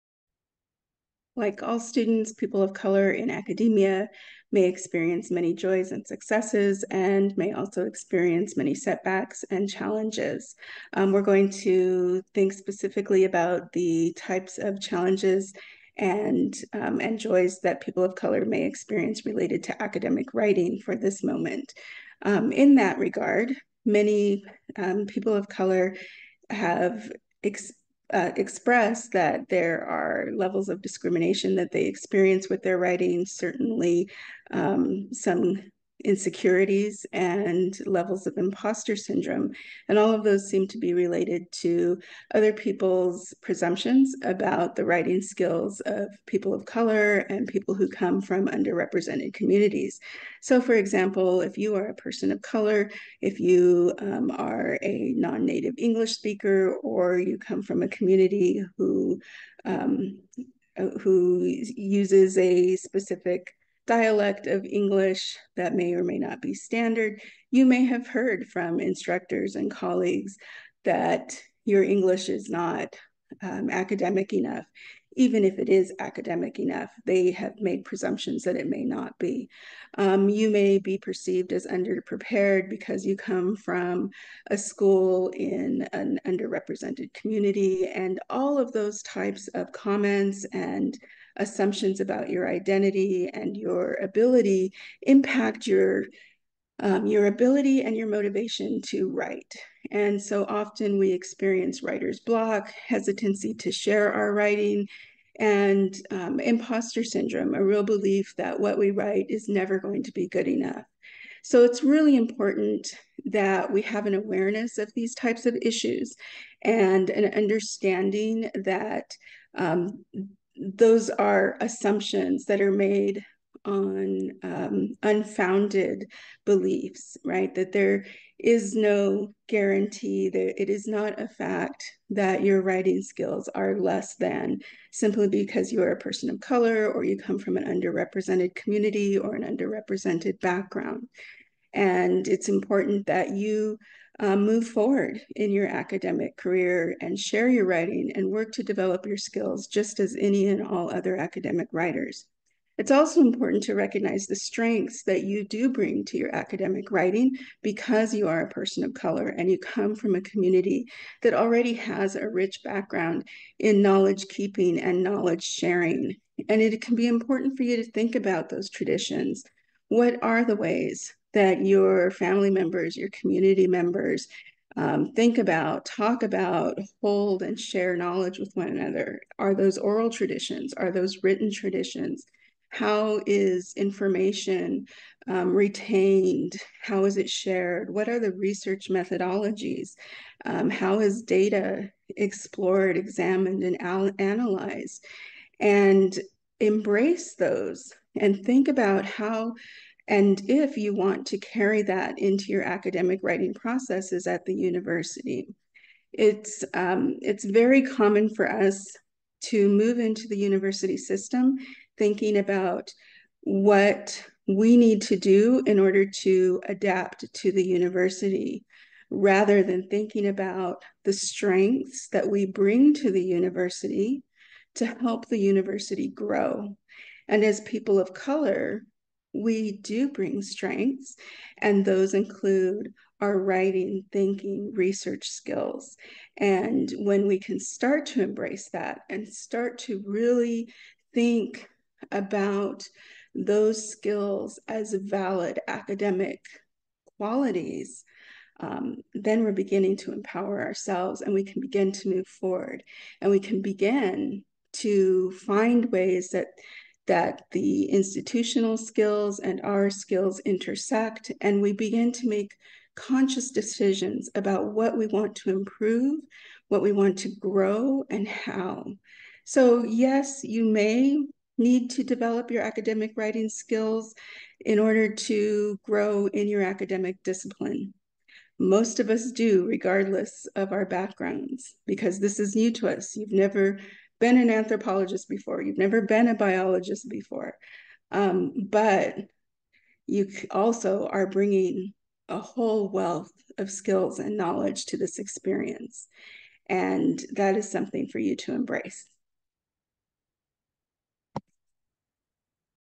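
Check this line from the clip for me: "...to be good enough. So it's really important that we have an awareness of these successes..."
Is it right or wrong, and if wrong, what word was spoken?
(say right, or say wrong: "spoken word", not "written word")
wrong: "types", not "successes".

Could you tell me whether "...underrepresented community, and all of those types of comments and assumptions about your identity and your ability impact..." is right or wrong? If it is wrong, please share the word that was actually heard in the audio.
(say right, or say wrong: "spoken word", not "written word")
right.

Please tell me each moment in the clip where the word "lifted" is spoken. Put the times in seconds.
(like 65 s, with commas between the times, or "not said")
not said.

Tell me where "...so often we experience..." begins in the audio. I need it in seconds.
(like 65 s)
100 s.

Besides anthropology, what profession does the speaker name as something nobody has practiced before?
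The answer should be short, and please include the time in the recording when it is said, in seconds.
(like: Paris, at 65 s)
biologist, at 286 s.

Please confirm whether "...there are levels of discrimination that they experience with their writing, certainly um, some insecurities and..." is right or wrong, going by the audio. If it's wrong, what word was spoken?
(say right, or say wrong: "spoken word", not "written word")
right.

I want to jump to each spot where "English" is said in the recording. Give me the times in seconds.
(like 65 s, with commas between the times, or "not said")
55 s, 64 s, 71 s.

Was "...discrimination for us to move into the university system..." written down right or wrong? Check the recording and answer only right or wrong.
wrong.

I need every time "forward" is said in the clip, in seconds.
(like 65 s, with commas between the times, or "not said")
144 s, 252 s.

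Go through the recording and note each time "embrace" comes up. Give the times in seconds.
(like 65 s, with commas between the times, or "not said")
196 s, 238 s, 298 s.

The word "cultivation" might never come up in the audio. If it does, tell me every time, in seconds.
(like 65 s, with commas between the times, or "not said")
not said.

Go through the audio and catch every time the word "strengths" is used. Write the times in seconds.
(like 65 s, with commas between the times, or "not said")
154 s, 221 s, 230 s.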